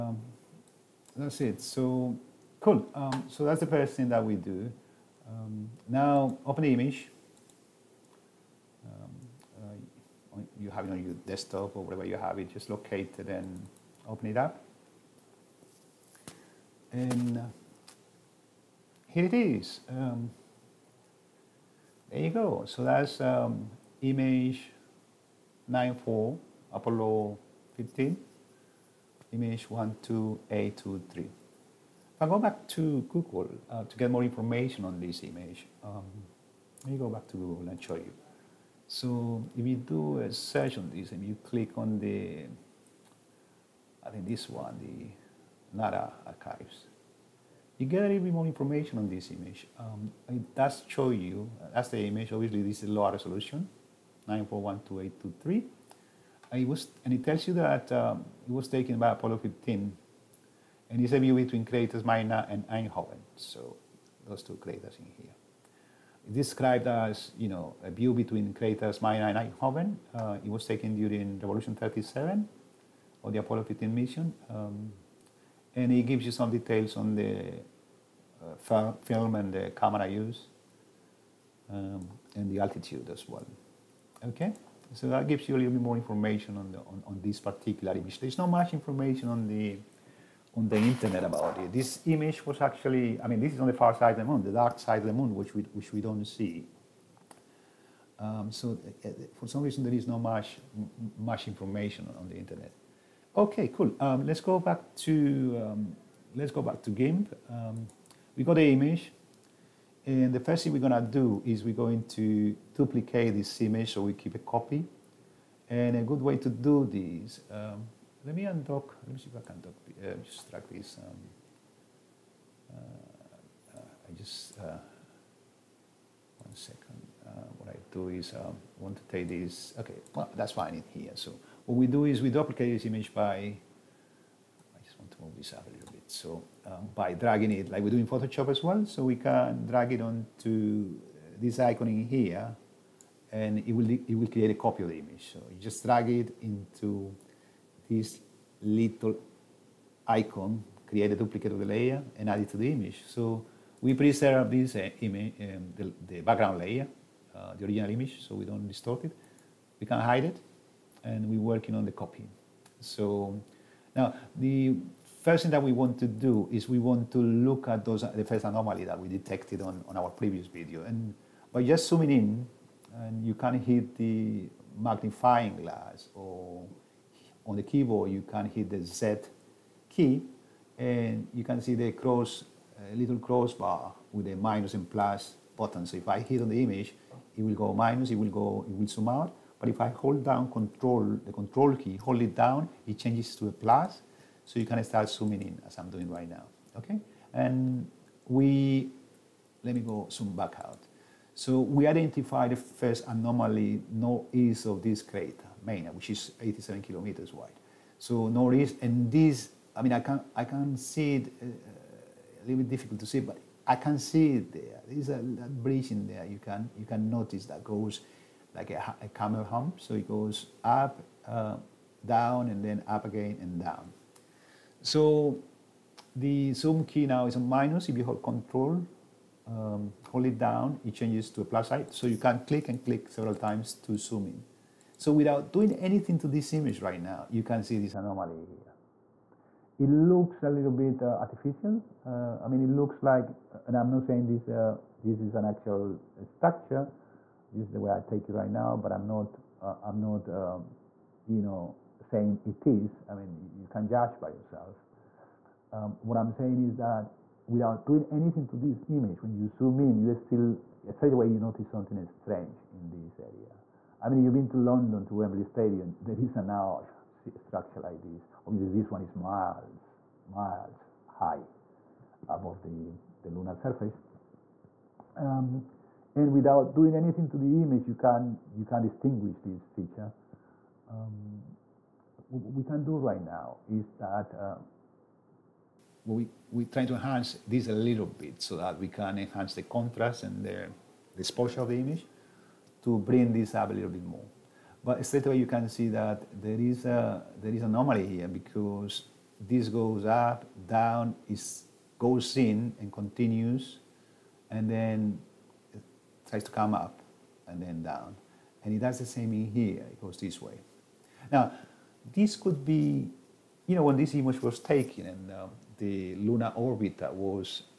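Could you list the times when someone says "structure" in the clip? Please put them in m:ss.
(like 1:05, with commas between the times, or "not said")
4:06, 4:27.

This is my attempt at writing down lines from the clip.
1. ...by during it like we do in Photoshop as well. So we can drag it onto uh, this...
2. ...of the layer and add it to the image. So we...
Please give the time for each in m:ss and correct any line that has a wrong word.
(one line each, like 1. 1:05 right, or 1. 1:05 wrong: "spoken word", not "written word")
1. 2:16 wrong: "dragging", not "during"
2. 2:31 right.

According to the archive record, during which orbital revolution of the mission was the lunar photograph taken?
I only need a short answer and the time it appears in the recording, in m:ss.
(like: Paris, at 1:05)
Revolution 37, at 1:11.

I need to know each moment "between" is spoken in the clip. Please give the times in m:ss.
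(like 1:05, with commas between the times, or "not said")
1:01, 1:08.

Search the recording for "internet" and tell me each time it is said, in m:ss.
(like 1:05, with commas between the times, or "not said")
1:30, 1:42.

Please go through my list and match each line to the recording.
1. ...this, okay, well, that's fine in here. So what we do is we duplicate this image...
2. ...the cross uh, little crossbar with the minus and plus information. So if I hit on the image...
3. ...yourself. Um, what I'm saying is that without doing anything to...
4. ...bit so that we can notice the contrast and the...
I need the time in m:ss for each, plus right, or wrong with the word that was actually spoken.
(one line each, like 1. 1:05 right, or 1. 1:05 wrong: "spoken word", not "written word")
1. 2:09 right
2. 3:01 wrong: "button", not "information"
3. 4:14 right
4. 4:48 wrong: "enhance", not "notice".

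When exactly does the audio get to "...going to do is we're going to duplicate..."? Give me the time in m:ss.
1:50.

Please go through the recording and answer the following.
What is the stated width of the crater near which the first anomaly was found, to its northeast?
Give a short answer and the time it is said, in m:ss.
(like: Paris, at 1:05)
87 kilometers, at 3:26.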